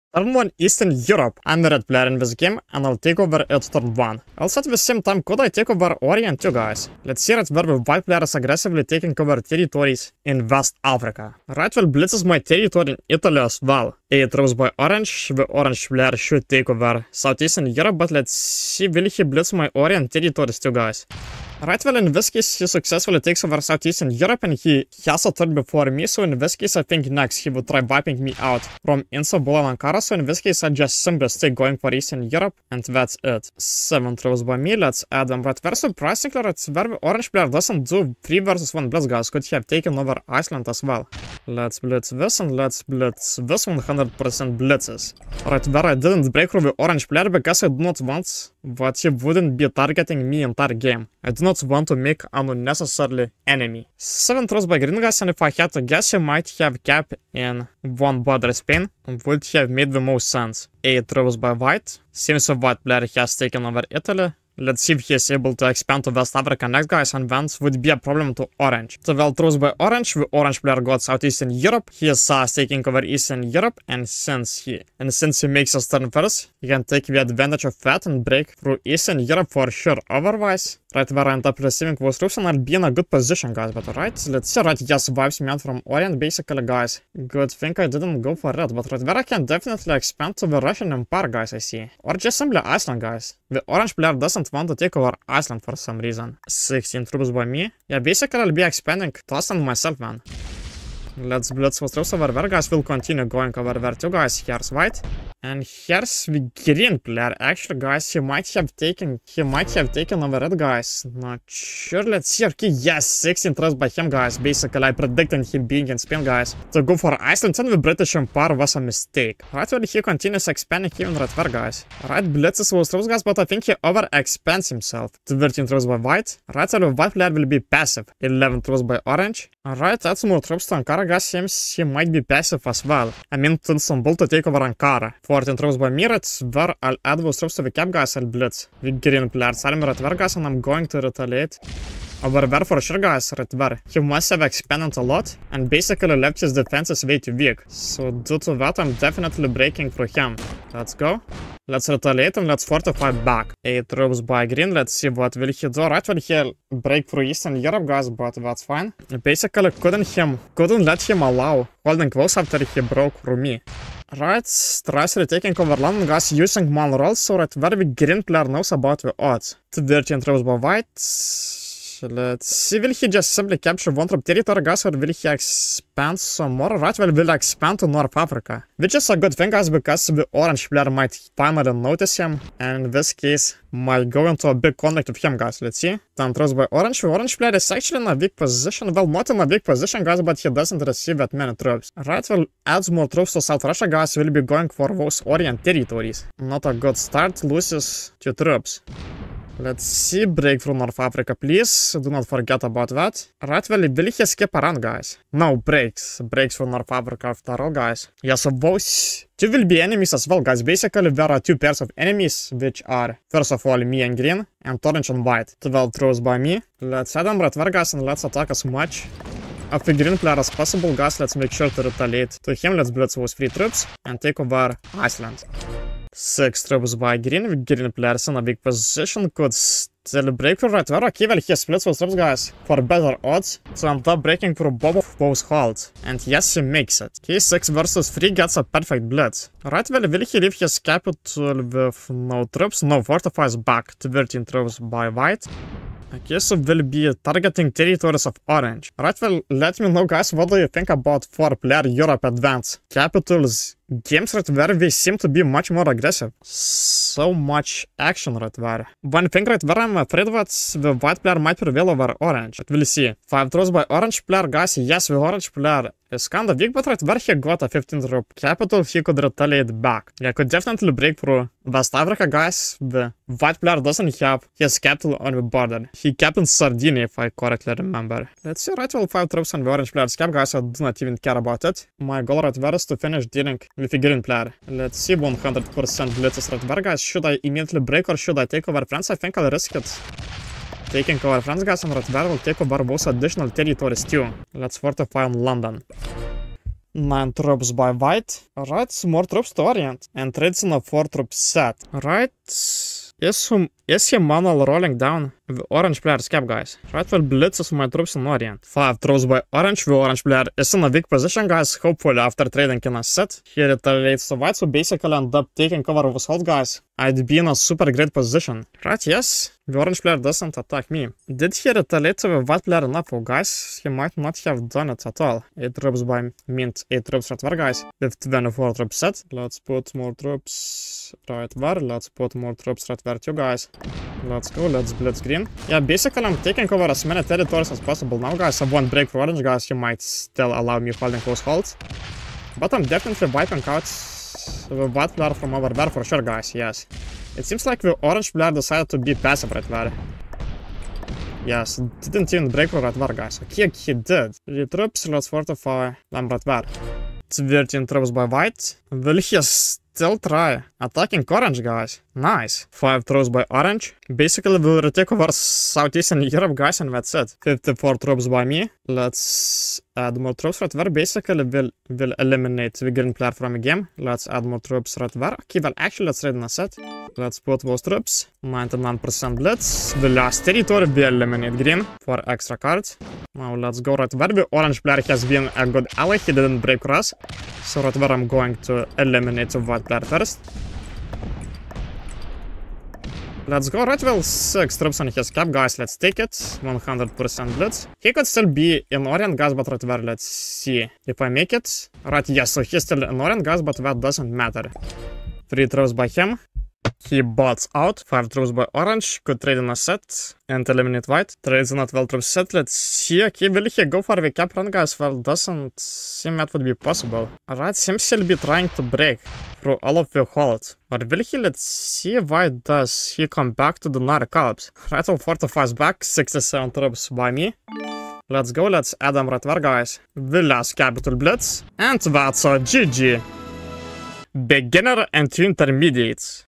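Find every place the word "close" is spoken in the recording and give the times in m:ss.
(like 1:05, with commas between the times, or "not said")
2:42, 5:41.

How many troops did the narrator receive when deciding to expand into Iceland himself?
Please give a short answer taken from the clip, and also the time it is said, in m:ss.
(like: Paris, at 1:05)
16, at 1:36.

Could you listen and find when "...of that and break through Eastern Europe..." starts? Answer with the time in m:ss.
1:17.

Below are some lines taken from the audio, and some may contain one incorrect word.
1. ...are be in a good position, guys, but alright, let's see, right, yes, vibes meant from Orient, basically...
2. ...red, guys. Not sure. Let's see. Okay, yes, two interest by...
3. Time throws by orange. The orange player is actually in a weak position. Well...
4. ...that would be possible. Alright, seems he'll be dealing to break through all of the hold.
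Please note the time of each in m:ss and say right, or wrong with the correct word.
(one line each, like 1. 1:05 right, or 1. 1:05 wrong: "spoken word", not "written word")
1. 1:22 right
2. 1:50 wrong: "six", not "two"
3. 3:06 right
4. 6:56 wrong: "trying", not "dealing".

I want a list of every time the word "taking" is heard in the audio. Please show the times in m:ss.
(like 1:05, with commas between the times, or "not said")
0:08, 1:12, 2:45, 4:50, 5:15, 5:36.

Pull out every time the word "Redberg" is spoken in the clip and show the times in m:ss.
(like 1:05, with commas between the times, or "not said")
4:46, 4:51.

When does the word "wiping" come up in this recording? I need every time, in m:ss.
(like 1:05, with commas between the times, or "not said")
0:27, 5:43.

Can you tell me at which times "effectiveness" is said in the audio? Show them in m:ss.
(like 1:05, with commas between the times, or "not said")
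not said.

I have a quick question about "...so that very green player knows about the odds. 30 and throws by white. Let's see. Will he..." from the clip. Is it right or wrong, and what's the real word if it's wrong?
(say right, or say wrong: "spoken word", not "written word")
right.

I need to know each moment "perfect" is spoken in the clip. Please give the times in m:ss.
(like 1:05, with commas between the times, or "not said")
3:58.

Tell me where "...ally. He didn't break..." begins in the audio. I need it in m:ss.
6:25.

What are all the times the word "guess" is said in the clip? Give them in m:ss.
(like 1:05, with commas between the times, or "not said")
0:55, 4:06.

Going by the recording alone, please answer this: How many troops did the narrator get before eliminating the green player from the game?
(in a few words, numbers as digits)
54.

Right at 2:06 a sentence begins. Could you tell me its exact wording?
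Right side of white player will be passive.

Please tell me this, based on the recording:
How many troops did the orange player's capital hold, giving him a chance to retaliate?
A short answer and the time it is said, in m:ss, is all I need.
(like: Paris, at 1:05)
15, at 4:27.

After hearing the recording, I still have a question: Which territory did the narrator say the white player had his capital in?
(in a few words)
Sardinia.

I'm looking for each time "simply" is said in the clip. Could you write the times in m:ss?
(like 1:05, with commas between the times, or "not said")
0:31, 1:32, 2:53.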